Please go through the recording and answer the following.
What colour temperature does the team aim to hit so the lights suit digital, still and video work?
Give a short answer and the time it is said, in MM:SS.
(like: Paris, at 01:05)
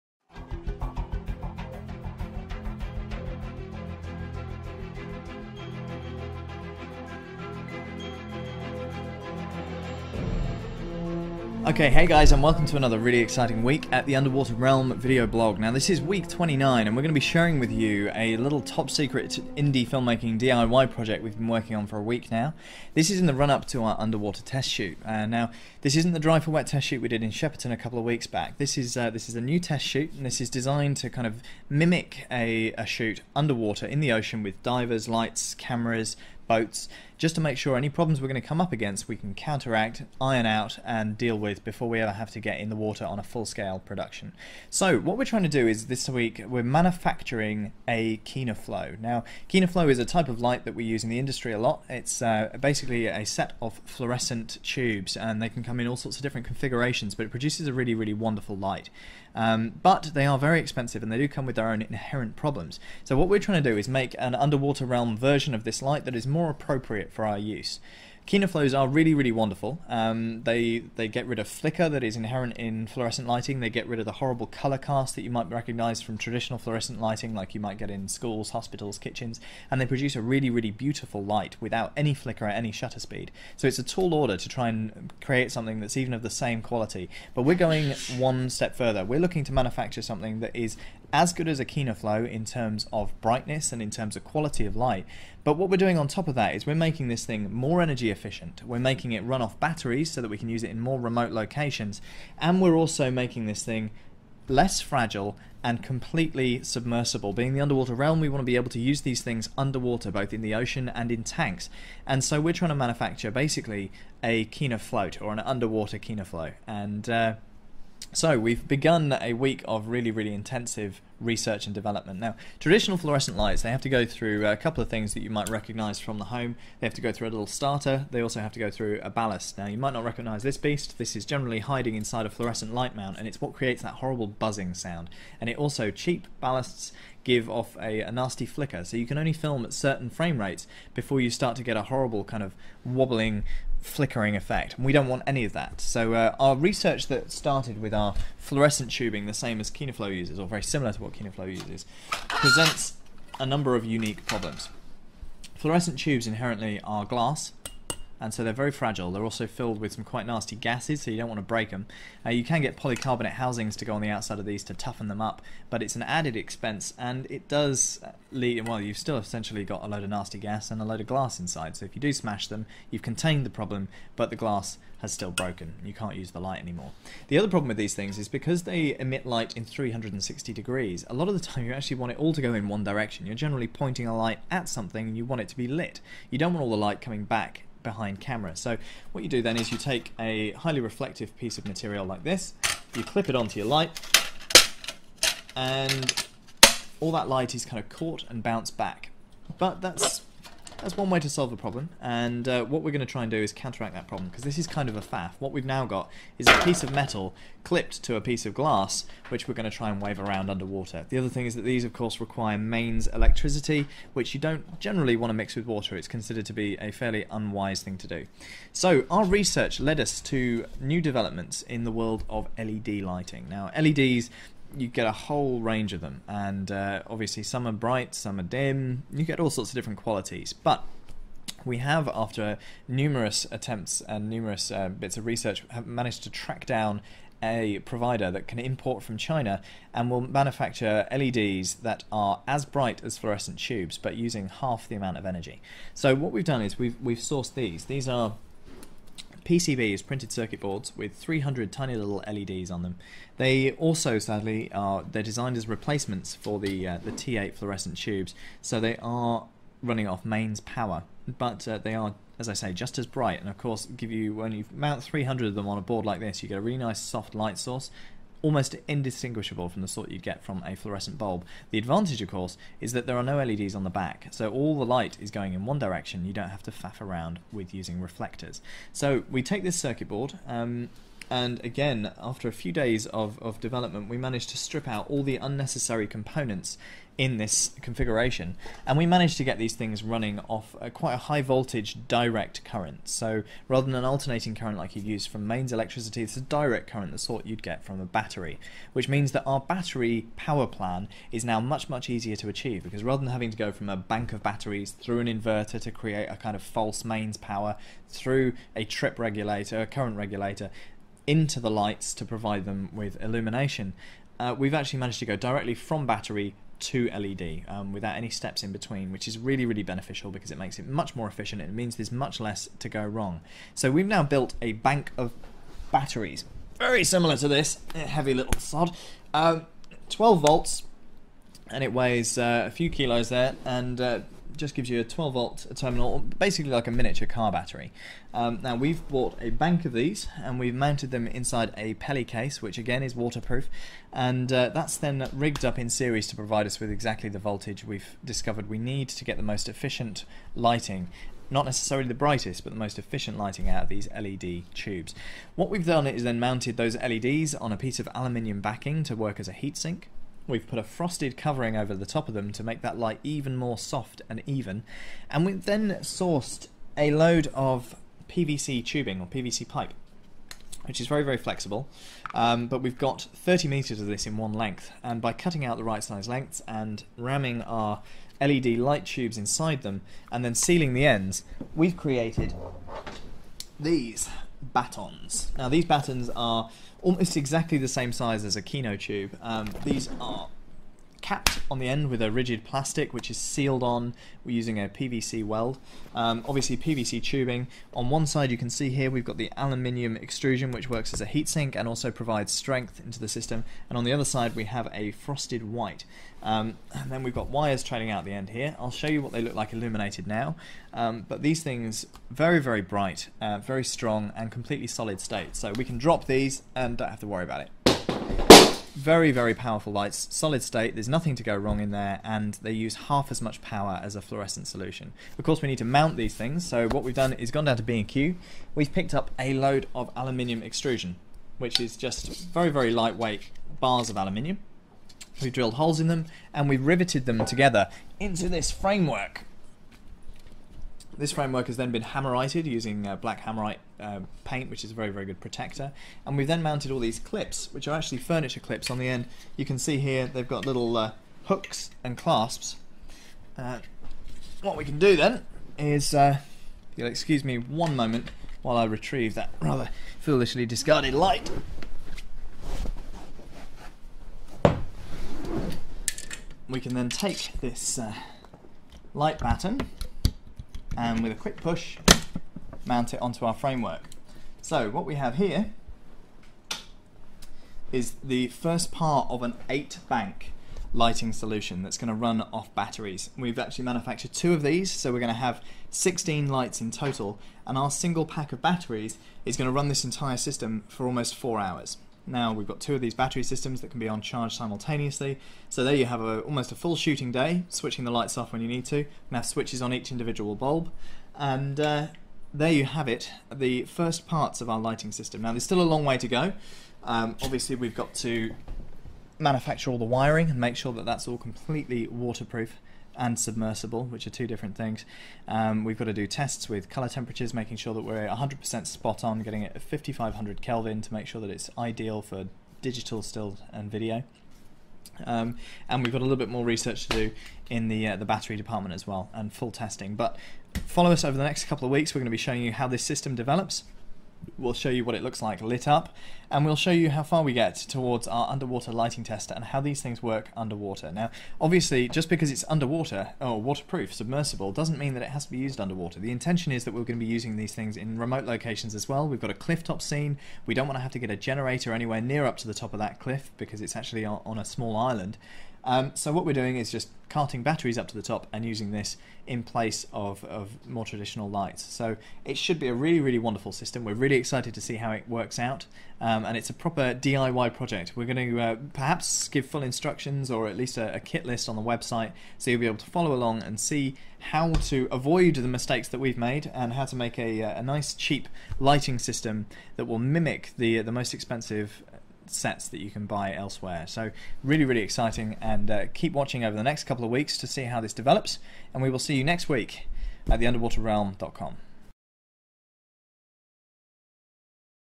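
5500 Kelvin, at 08:39.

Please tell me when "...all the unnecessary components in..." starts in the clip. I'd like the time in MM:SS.
04:45.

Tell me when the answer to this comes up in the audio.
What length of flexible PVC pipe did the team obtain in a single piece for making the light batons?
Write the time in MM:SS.
06:13.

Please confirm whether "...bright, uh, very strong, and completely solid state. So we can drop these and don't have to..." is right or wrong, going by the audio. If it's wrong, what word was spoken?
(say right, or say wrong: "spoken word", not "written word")
right.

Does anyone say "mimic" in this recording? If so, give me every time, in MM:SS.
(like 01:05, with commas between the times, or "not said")
00:31, 09:40.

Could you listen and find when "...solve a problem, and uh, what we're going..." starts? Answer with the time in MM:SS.
03:21.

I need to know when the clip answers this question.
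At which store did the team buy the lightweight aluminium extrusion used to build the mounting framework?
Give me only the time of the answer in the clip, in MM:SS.
07:07.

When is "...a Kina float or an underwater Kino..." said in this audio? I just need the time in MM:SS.
01:54.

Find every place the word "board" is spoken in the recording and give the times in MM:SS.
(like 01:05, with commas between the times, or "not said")
04:10, 04:25, 04:40.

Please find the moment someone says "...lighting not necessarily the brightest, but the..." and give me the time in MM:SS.
05:50.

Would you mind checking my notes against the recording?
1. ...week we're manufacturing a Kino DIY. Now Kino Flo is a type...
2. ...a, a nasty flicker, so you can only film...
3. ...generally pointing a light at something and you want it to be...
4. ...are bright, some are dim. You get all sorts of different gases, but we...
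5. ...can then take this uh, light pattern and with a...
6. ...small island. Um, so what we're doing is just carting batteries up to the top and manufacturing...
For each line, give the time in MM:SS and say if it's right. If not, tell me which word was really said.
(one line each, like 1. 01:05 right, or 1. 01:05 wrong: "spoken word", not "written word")
1. 00:46 wrong: "Flo", not "DIY"
2. 02:17 right
3. 03:03 right
4. 03:47 wrong: "qualities", not "gases"
5. 07:46 right
6. 09:14 wrong: "using", not "manufacturing".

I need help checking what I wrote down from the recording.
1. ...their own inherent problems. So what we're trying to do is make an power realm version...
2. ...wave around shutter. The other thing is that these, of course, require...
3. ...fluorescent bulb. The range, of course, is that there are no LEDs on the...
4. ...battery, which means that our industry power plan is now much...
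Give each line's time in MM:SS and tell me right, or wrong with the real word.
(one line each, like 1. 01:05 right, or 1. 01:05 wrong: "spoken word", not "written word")
1. 01:01 wrong: "underwater", not "power"
2. 03:30 wrong: "underwater", not "shutter"
3. 04:30 wrong: "advantage", not "range"
4. 04:58 wrong: "battery", not "industry".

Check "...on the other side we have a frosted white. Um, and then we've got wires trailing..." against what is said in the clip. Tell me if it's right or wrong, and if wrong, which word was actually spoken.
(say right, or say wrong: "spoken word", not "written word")
right.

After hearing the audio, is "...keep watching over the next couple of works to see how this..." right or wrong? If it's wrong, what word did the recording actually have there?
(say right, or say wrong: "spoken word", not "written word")
wrong: "weeks", not "works".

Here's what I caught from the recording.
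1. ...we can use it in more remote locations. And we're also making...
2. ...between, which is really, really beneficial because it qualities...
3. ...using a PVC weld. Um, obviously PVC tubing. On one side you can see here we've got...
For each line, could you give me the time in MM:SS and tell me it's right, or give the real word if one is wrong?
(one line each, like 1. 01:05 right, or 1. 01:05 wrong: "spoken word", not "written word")
1. 01:40 right
2. 05:18 wrong: "makes", not "qualities"
3. 06:34 right.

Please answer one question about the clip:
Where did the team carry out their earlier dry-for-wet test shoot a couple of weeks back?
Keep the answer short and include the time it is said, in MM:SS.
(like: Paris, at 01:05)
Shepperton, at 00:27.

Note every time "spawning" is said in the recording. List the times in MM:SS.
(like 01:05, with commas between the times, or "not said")
not said.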